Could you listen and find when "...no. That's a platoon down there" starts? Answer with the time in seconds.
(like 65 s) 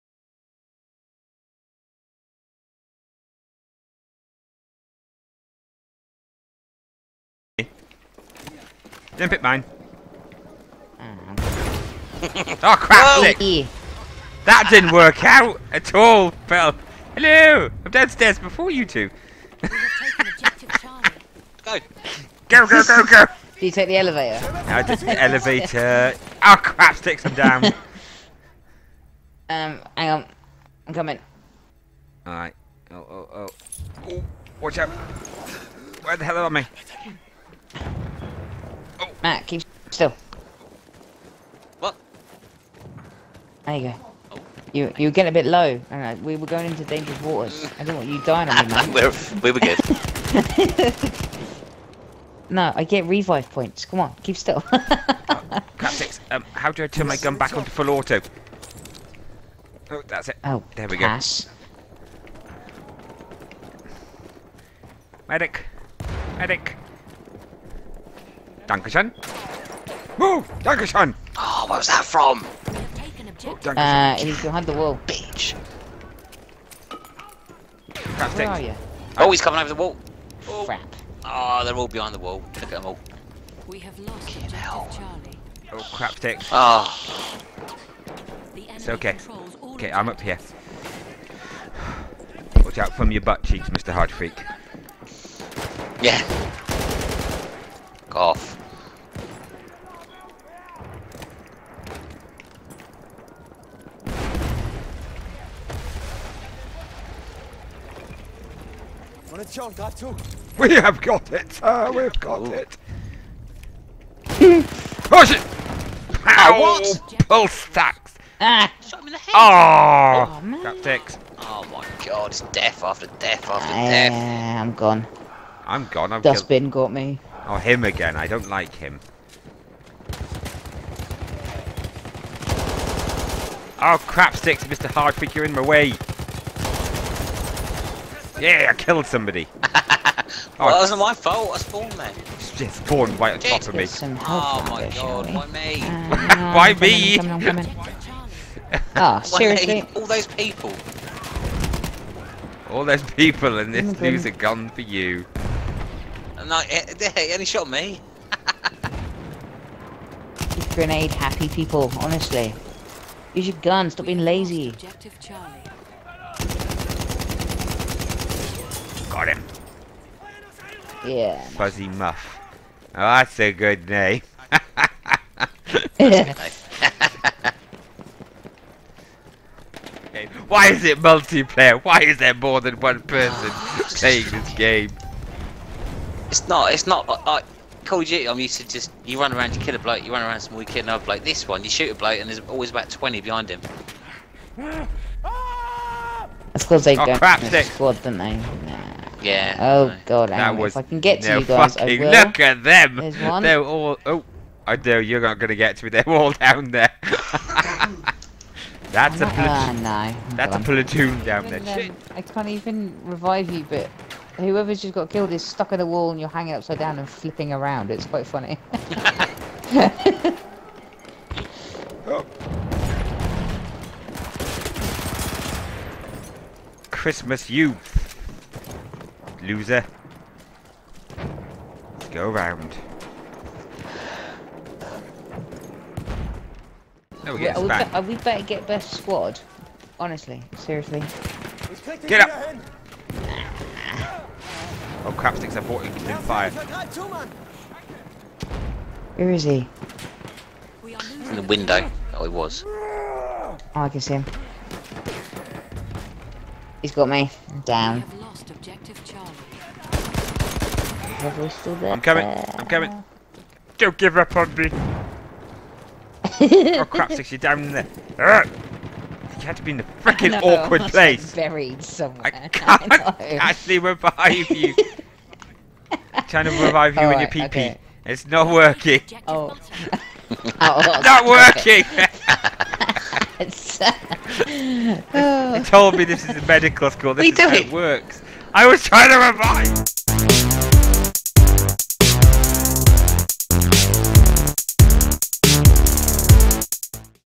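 210 s.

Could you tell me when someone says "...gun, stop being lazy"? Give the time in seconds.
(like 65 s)
163 s.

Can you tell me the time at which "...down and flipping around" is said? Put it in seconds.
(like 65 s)
216 s.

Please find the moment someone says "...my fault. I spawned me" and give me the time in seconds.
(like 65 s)
140 s.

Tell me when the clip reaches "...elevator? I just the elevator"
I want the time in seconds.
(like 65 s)
23 s.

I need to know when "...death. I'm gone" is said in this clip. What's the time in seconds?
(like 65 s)
123 s.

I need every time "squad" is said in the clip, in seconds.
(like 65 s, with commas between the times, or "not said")
197 s, 238 s.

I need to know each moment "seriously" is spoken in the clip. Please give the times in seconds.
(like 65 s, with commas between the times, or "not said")
149 s, 240 s.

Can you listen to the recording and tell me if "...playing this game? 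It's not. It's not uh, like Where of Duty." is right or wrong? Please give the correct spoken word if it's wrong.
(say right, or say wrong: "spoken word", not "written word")
wrong: "Call", not "Where".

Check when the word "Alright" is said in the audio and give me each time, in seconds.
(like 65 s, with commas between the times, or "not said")
32 s.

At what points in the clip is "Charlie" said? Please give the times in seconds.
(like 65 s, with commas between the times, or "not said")
84 s, 165 s.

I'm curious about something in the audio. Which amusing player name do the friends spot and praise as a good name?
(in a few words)
Fuzzy Muff.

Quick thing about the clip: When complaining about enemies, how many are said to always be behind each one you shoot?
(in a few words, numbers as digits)
20.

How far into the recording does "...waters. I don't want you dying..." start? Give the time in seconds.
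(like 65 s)
47 s.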